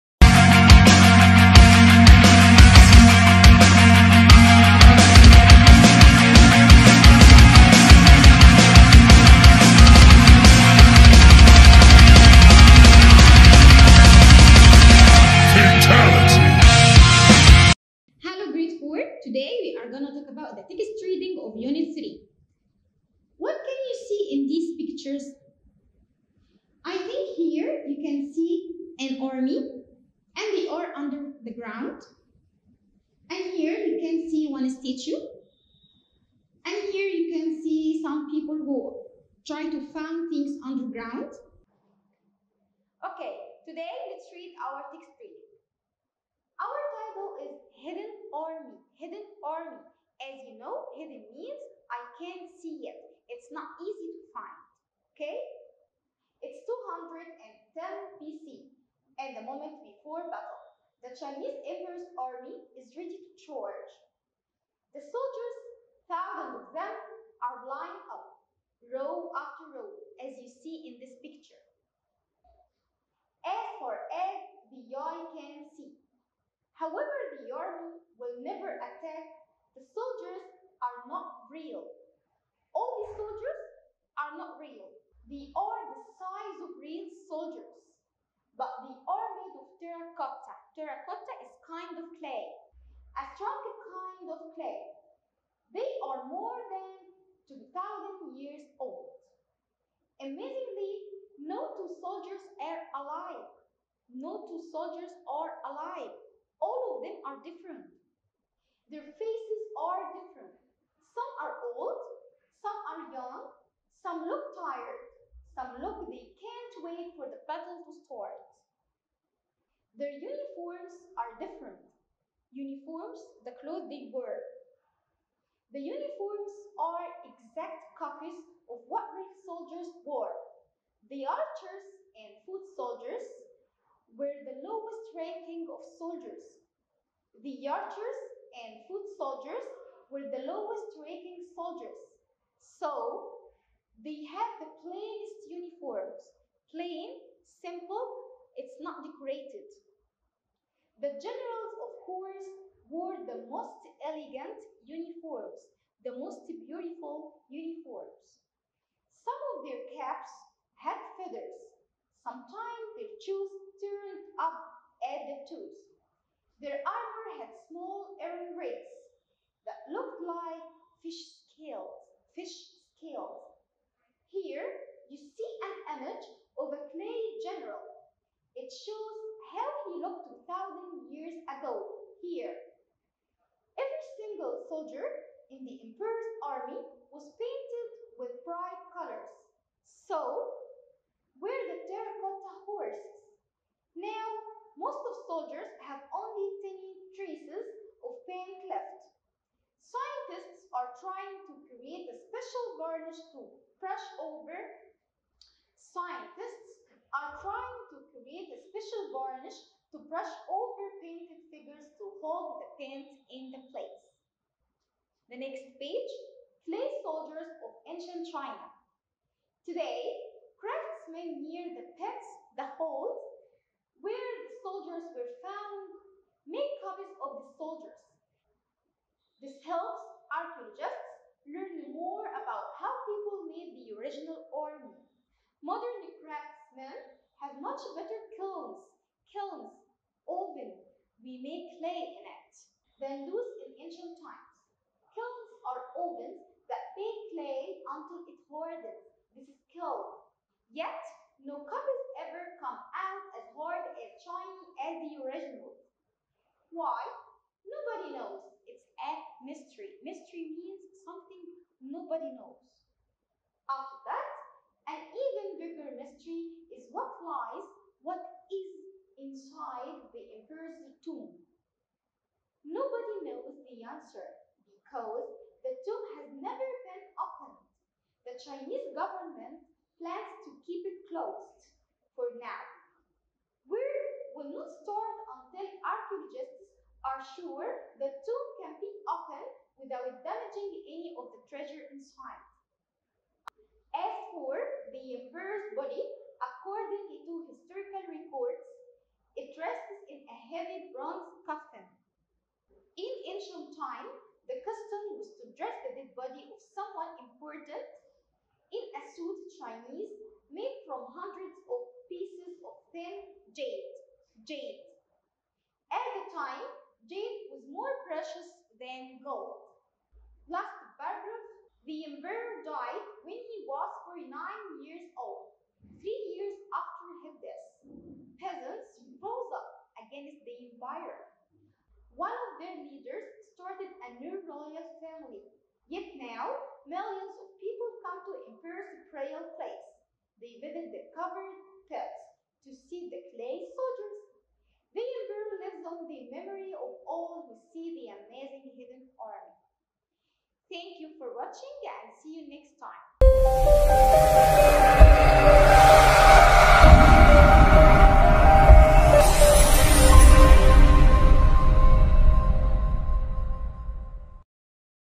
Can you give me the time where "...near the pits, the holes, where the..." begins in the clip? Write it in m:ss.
3:41.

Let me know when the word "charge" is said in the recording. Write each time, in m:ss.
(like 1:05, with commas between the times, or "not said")
1:03.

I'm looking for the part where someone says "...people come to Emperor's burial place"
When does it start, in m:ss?
5:37.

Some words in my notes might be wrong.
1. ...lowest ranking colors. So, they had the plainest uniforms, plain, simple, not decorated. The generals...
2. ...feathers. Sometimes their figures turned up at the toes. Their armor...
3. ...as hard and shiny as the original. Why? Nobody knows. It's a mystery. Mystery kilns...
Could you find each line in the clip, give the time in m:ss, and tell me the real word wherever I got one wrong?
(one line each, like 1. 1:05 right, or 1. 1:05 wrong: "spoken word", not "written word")
1. 2:20 wrong: "soldiers", not "colors"
2. 2:41 wrong: "shoes", not "figures"
3. 4:13 wrong: "means", not "kilns".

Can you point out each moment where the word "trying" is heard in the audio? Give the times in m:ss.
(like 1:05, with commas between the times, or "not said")
3:21, 3:27.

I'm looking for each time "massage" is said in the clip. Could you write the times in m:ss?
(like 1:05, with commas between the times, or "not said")
not said.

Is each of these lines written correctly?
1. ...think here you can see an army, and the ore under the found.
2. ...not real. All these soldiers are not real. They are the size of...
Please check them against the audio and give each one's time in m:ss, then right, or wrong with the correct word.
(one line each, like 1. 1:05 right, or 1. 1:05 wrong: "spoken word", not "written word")
1. 0:26 wrong: "ground", not "found"
2. 1:21 right.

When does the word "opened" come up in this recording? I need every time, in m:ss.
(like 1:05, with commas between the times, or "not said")
4:37, 4:49.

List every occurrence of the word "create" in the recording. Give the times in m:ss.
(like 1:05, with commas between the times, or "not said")
3:21, 3:28.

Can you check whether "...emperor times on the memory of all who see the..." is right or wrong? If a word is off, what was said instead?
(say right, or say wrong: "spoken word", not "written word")
wrong: "lives", not "times".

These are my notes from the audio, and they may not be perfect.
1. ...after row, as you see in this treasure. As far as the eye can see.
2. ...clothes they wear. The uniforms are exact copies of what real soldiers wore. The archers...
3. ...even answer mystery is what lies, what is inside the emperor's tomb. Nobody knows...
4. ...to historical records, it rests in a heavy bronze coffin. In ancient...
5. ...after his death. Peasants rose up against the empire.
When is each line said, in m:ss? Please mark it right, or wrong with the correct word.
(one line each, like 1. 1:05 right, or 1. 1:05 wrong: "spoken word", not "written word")
1. 1:09 wrong: "picture", not "treasure"
2. 2:03 right
3. 4:25 wrong: "bigger", not "answer"
4. 4:57 right
5. 5:26 right.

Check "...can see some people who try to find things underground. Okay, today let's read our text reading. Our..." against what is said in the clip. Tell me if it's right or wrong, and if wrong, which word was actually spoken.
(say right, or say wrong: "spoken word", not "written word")
right.